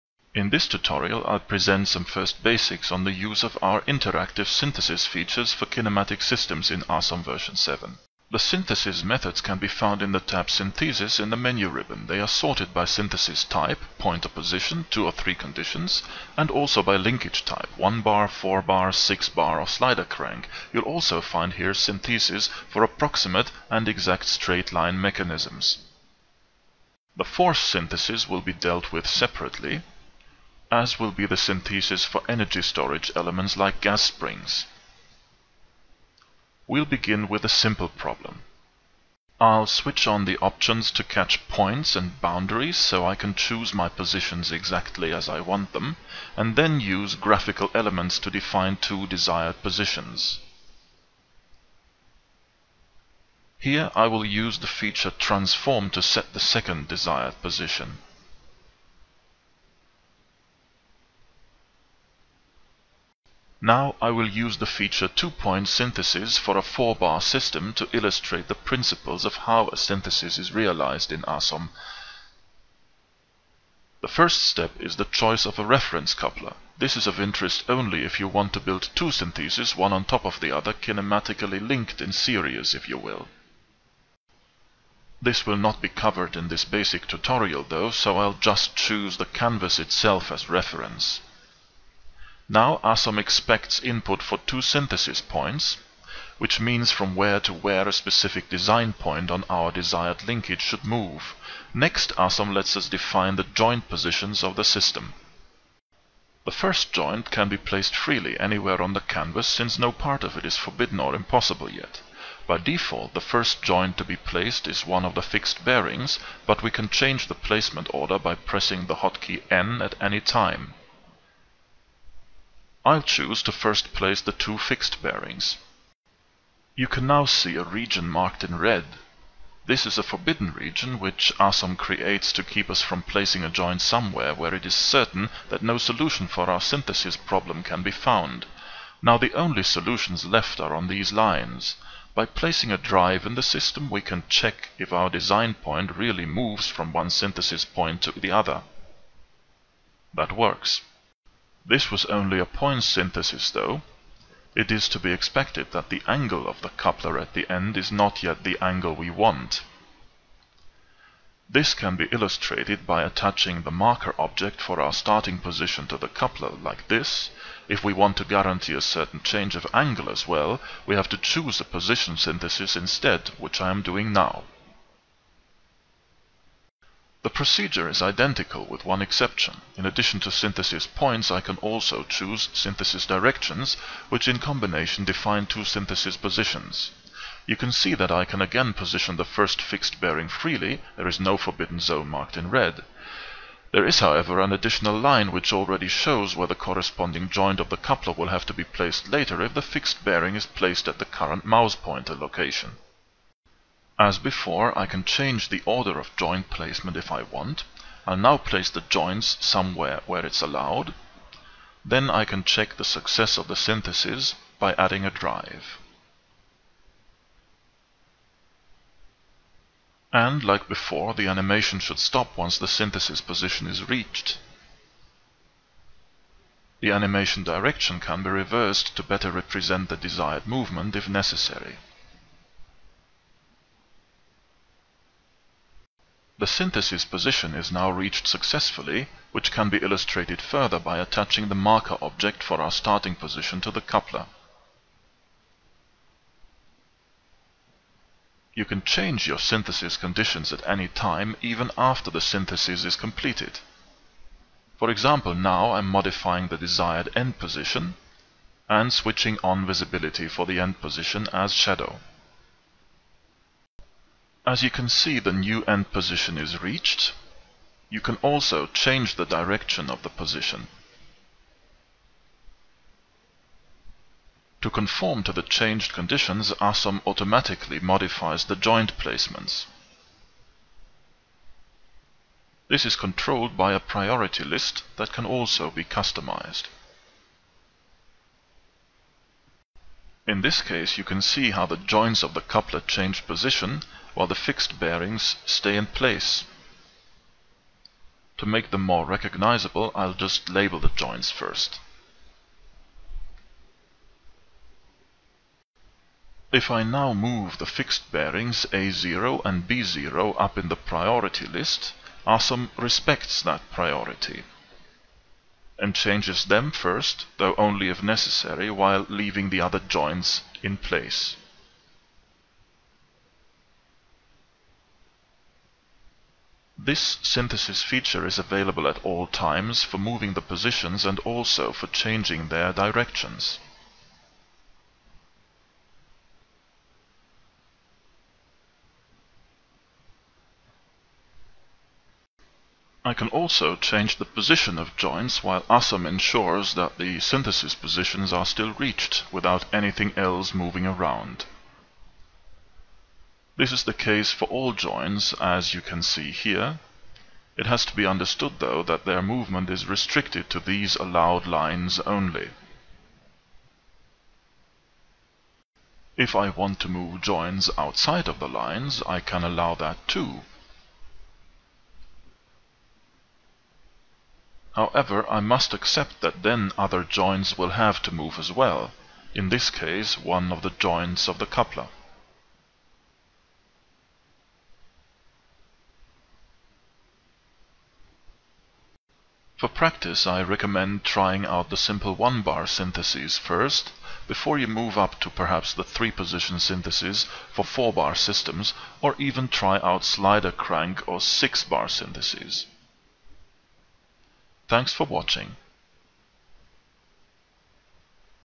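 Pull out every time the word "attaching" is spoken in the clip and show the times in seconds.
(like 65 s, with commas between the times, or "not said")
163 s, 240 s.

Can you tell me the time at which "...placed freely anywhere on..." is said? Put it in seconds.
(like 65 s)
107 s.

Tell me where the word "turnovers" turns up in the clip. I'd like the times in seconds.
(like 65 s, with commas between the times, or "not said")
not said.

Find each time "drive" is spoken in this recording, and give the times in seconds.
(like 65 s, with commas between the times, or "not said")
142 s, 215 s.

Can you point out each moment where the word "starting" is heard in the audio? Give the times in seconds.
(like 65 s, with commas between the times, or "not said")
164 s, 242 s.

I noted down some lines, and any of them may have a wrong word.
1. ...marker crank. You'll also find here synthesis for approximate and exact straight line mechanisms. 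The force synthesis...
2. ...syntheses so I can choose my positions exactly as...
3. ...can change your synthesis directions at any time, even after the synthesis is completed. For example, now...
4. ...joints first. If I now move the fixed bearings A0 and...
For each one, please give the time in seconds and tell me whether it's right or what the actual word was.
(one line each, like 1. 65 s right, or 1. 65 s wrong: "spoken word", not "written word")
1. 19 s wrong: "slider", not "marker"
2. 42 s wrong: "boundaries", not "syntheses"
3. 248 s wrong: "conditions", not "directions"
4. 300 s right.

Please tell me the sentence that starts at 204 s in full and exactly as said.
As before, I can change the order of joint placement if I want.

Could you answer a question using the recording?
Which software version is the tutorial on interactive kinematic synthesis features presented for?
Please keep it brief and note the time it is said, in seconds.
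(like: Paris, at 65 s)
7, at 7 s.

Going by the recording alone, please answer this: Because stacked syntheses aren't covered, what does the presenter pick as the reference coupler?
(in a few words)
the canvas itself.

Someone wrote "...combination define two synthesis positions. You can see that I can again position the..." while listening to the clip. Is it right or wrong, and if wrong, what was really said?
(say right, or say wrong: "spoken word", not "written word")
right.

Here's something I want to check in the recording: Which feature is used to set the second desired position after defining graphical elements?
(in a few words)
transform.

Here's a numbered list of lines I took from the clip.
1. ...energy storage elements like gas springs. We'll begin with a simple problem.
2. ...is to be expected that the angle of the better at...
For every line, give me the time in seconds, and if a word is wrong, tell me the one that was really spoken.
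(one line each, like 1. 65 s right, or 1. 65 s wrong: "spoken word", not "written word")
1. 32 s right
2. 154 s wrong: "coupler", not "better".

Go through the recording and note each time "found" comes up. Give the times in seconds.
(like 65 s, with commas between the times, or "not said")
9 s, 137 s.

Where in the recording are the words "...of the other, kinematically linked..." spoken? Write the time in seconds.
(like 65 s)
80 s.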